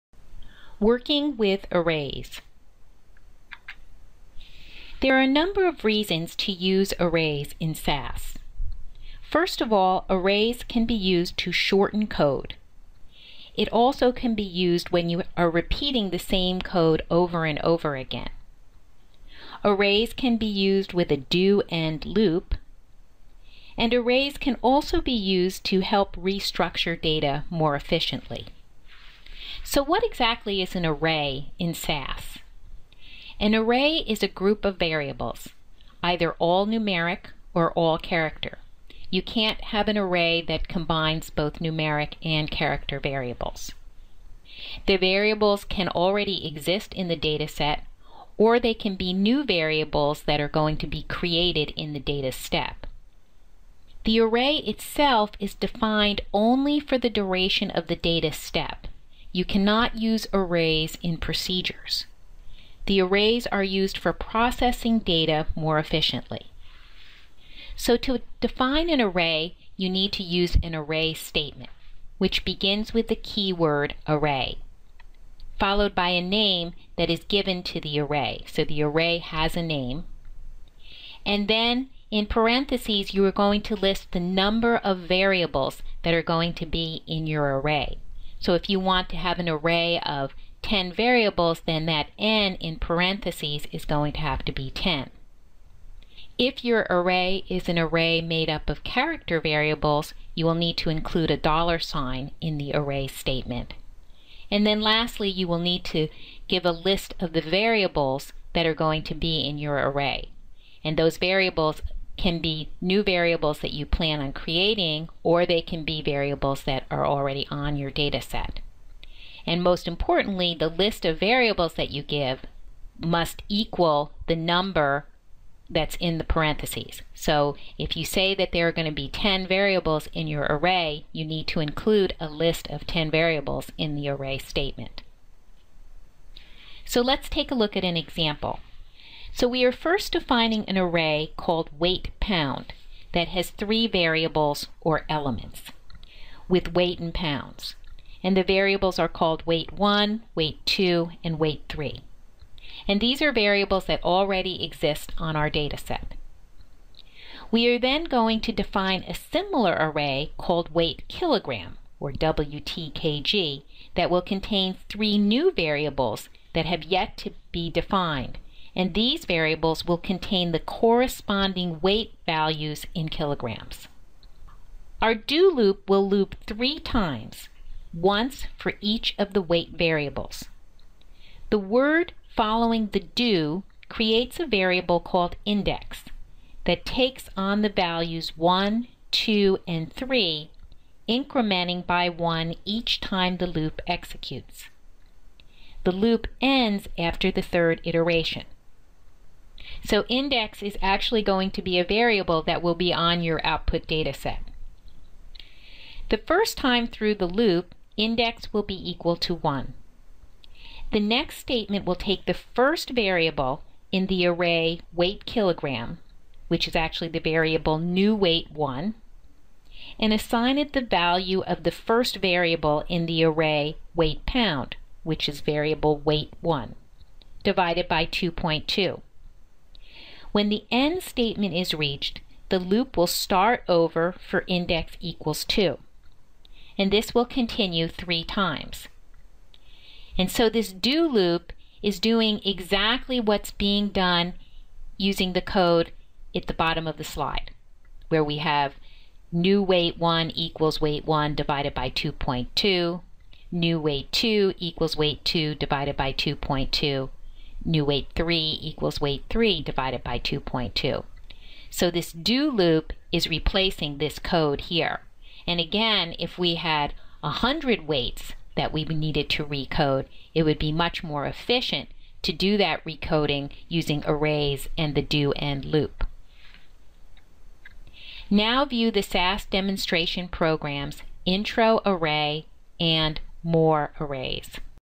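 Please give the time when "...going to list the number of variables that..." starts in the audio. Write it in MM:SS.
01:23.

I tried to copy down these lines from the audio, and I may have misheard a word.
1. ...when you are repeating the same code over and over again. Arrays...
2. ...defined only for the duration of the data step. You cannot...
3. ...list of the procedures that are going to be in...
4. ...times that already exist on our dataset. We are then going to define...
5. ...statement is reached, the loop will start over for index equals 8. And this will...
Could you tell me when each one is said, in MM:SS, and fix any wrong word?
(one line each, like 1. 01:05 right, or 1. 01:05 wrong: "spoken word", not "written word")
1. 00:14 right
2. 00:55 right
3. 01:46 wrong: "variables", not "procedures"
4. 02:33 wrong: "variables", not "times"
5. 03:51 wrong: "2", not "8".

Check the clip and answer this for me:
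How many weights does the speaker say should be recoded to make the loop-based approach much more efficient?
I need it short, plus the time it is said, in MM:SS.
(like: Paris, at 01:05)
100, at 04:27.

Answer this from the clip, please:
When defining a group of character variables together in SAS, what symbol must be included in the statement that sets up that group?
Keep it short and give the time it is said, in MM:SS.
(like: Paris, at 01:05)
dollar sign, at 01:41.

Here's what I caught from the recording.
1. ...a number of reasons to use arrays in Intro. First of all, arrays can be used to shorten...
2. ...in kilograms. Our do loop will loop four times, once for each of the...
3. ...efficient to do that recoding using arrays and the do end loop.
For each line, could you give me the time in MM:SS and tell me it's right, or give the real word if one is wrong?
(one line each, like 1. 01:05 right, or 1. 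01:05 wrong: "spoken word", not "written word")
1. 00:05 wrong: "SAS", not "Intro"
2. 02:52 wrong: "three", not "four"
3. 04:31 right.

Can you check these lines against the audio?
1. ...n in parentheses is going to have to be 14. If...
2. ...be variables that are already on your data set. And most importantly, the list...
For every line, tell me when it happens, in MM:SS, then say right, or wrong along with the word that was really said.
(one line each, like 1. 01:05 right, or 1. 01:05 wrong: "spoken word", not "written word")
1. 01:32 wrong: "10", not "14"
2. 01:55 right.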